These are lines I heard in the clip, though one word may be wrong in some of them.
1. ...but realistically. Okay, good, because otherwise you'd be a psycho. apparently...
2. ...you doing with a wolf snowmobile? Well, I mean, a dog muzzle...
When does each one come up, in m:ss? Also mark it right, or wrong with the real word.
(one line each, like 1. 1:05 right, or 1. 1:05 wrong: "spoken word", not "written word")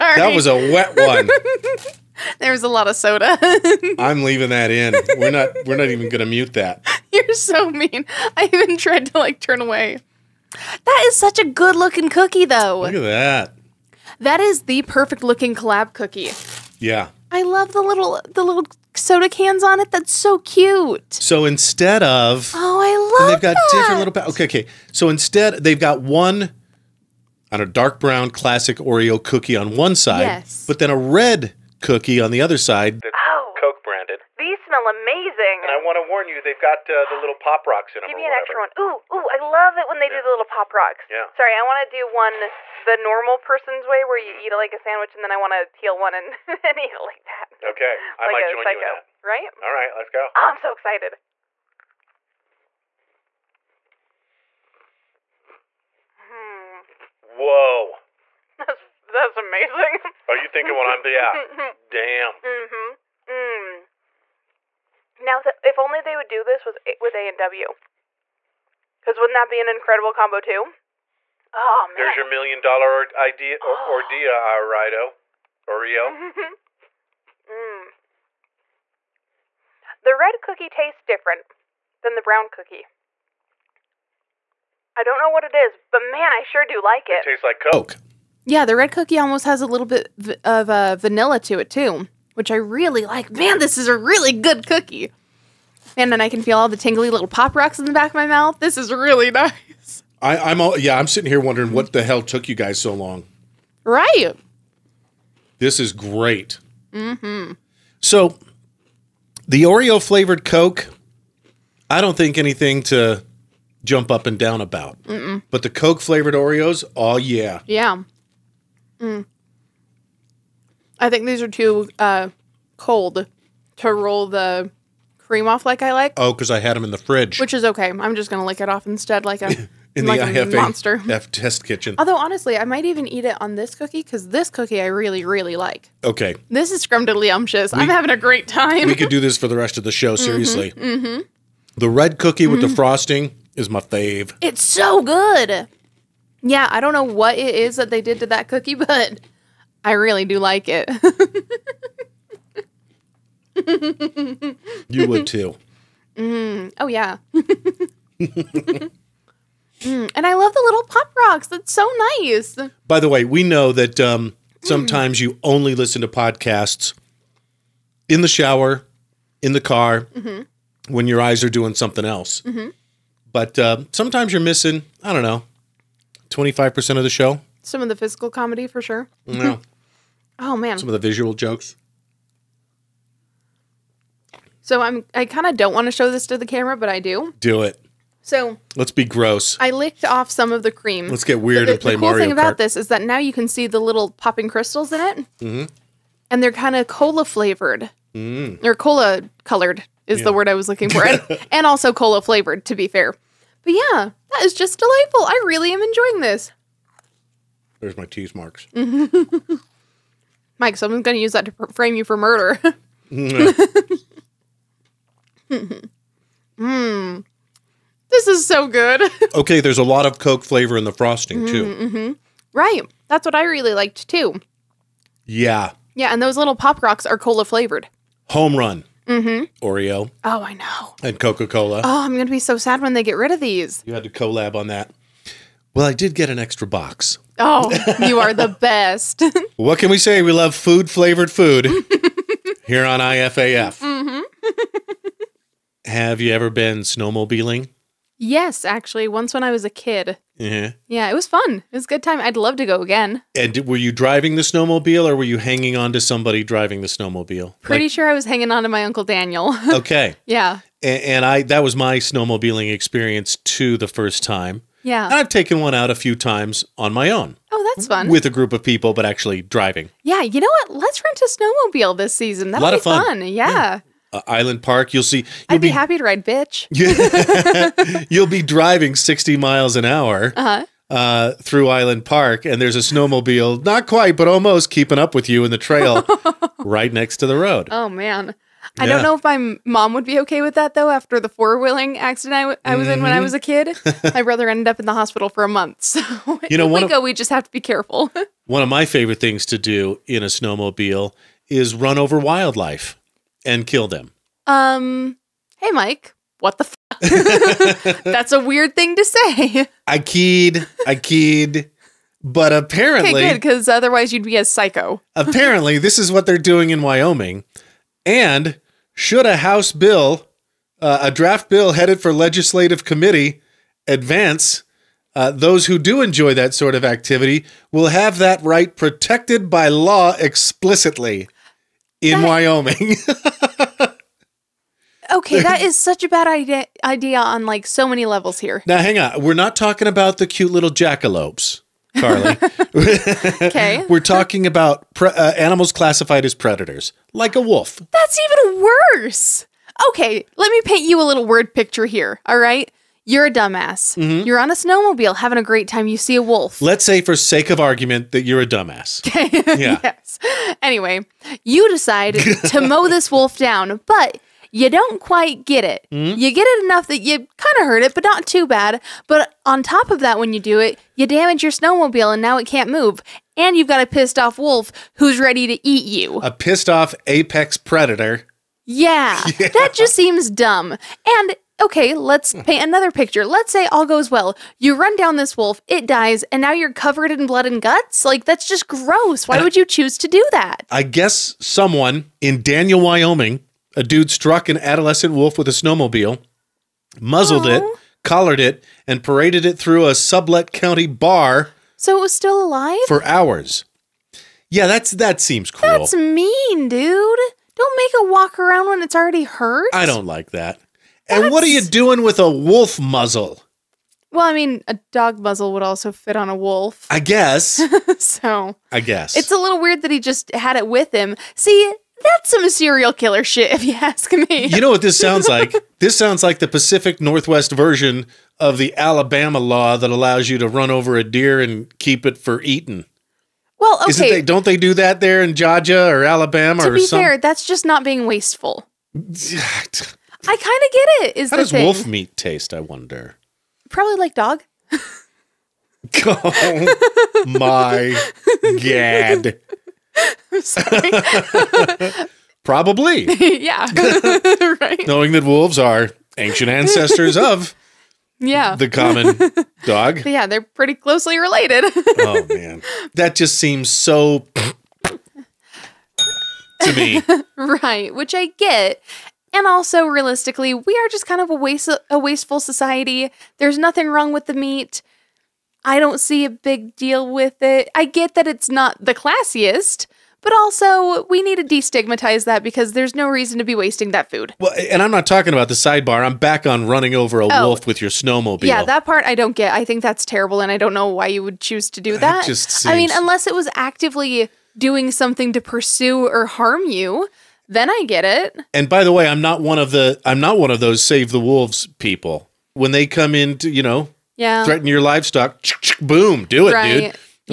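1. 5:12 wrong: "apparently", not "realistically"
2. 6:51 wrong: "muzzle", not "snowmobile".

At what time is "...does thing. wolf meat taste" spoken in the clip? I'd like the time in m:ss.
7:21.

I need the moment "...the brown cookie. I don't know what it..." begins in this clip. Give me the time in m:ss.
1:22.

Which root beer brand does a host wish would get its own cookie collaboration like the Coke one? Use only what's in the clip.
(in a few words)
A and W.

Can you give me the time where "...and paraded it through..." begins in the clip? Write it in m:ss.
6:38.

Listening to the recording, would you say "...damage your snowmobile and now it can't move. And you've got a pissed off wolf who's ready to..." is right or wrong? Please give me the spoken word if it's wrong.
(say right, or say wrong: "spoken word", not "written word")
right.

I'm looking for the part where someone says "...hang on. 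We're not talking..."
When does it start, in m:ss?
5:38.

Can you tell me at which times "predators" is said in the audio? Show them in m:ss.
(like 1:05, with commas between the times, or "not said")
5:46, 6:17.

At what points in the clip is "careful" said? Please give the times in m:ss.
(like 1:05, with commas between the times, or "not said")
4:57.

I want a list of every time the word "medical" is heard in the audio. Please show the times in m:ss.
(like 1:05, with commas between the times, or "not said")
not said.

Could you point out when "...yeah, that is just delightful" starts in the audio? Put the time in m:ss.
3:23.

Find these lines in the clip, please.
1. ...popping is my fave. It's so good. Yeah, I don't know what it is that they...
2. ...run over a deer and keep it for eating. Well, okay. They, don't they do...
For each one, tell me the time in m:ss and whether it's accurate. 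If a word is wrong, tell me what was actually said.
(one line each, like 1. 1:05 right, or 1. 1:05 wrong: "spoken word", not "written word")
1. 2:22 wrong: "frosting", not "popping"
2. 7:10 right.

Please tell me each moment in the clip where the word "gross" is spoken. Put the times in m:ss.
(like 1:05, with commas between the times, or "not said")
3:09, 6:28.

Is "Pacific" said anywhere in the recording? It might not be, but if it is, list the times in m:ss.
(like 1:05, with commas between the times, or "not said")
7:06.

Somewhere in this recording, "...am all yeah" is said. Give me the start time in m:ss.
1:40.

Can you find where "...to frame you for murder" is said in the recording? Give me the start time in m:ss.
3:31.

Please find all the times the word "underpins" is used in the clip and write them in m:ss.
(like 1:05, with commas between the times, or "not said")
not said.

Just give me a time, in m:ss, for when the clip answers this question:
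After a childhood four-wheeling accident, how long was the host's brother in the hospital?
4:55.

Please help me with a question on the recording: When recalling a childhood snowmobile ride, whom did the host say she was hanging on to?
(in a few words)
Uncle Daniel.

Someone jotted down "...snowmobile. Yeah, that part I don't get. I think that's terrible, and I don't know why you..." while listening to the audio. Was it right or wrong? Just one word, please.
right.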